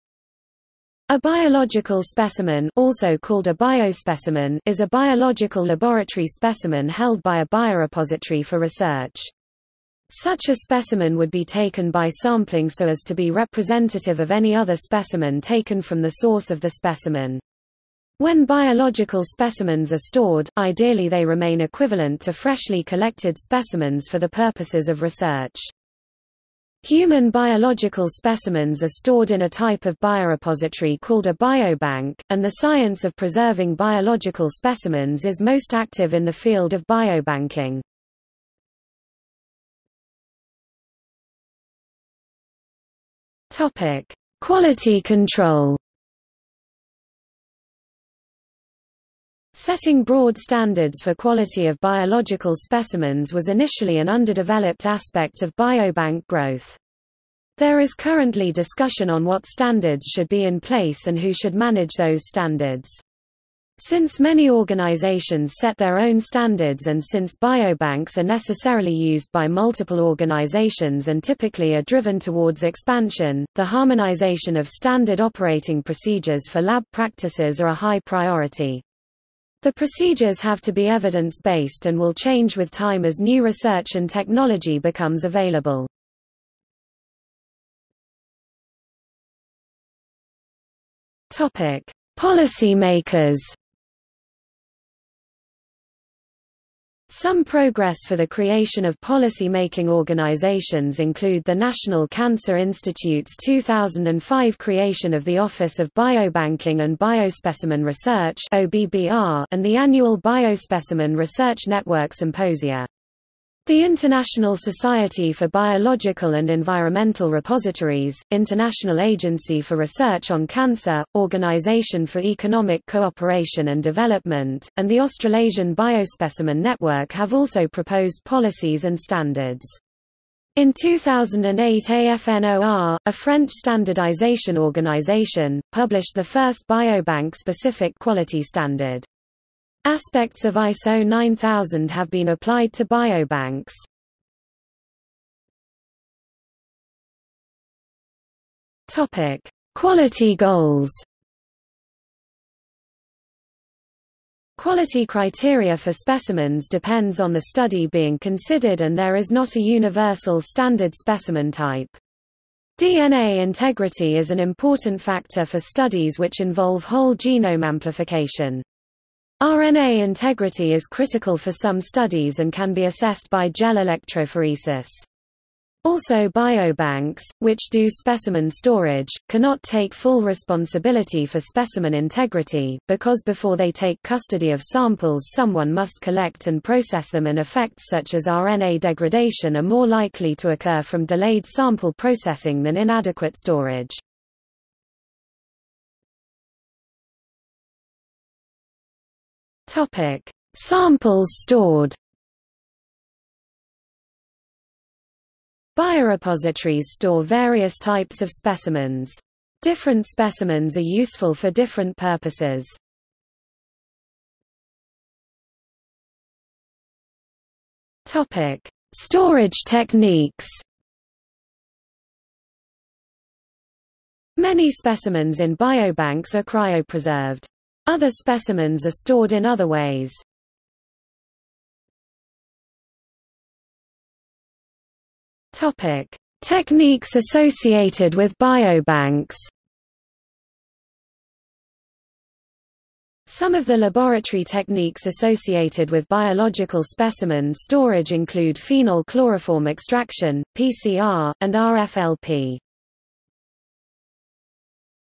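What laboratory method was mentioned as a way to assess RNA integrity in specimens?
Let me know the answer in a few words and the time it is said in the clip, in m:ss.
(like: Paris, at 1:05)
gel electrophoresis, at 2:53.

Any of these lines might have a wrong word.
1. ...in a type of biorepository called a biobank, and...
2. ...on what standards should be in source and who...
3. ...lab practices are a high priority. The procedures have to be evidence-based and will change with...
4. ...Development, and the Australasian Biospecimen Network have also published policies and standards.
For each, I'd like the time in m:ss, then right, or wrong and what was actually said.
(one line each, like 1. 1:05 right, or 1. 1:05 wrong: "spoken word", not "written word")
1. 0:29 right
2. 0:59 wrong: "place", not "source"
3. 1:16 right
4. 2:03 wrong: "proposed", not "published".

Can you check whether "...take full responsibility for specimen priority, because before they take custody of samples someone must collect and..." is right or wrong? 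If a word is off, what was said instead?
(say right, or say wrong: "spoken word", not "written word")
wrong: "integrity", not "priority".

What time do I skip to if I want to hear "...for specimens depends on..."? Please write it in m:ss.
2:35.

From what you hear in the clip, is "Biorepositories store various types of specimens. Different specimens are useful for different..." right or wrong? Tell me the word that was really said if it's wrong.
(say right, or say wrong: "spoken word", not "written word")
right.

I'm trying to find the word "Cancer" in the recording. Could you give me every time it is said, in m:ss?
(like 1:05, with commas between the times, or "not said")
1:42, 2:00.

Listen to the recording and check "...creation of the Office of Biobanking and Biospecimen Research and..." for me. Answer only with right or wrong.
right.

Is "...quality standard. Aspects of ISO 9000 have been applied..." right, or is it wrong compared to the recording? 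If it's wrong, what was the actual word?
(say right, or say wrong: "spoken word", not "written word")
right.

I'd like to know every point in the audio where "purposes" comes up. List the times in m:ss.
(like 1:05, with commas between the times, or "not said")
0:24, 3:31.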